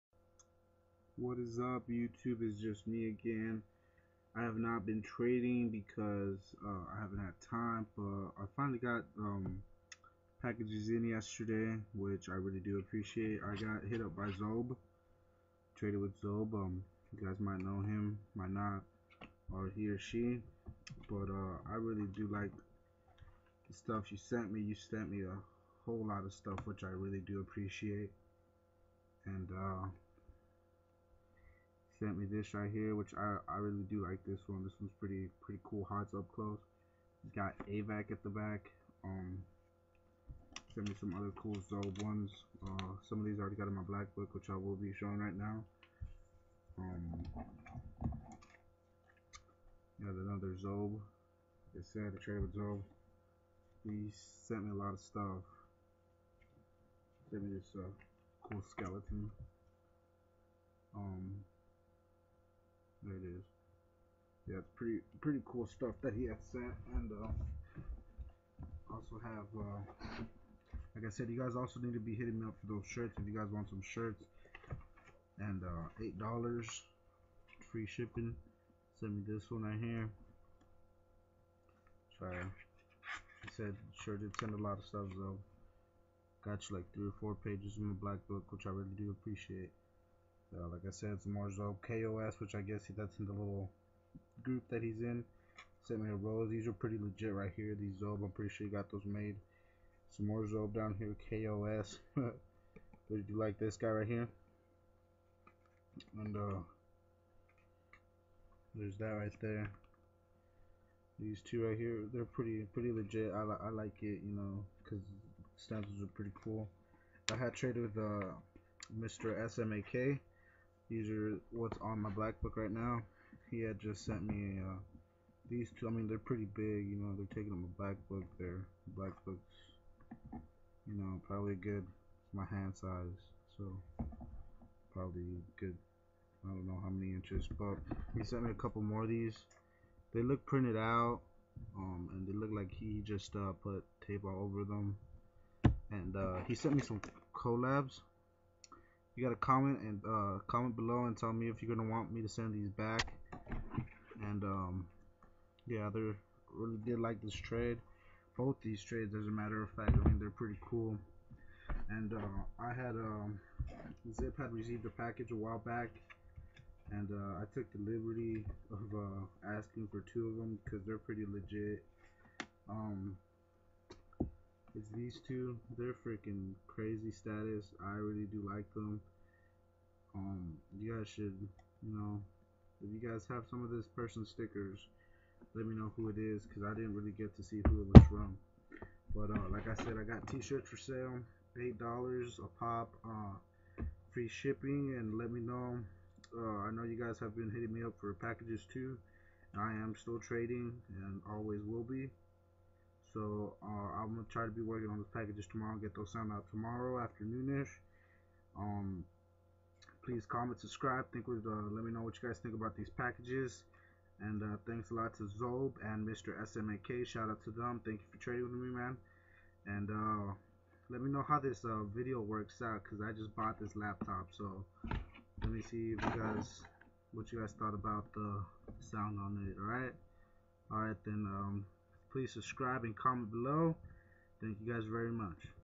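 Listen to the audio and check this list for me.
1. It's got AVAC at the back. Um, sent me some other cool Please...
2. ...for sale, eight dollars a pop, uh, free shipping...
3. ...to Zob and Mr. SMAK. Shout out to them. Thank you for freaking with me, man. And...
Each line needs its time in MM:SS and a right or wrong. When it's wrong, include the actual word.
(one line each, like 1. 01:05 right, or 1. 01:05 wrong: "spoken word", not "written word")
1. 00:37 wrong: "Zob", not "Please"
2. 03:10 right
3. 03:35 wrong: "trading", not "freaking".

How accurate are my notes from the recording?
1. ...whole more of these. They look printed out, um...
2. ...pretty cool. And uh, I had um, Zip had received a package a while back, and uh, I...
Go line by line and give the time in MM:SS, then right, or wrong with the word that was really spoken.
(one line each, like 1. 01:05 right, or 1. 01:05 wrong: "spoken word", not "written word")
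1. 02:18 wrong: "couple", not "whole"
2. 02:40 right.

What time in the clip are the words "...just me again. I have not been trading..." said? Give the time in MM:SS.
00:02.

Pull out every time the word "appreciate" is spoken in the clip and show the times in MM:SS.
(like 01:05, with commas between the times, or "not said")
00:12, 00:27, 01:29.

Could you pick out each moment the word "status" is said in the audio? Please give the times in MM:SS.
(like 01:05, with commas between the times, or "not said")
02:57.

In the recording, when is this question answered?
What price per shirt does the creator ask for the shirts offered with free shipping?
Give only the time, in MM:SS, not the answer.
01:16.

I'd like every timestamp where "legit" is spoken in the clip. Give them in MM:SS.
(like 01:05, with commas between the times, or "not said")
01:36, 01:52, 02:51.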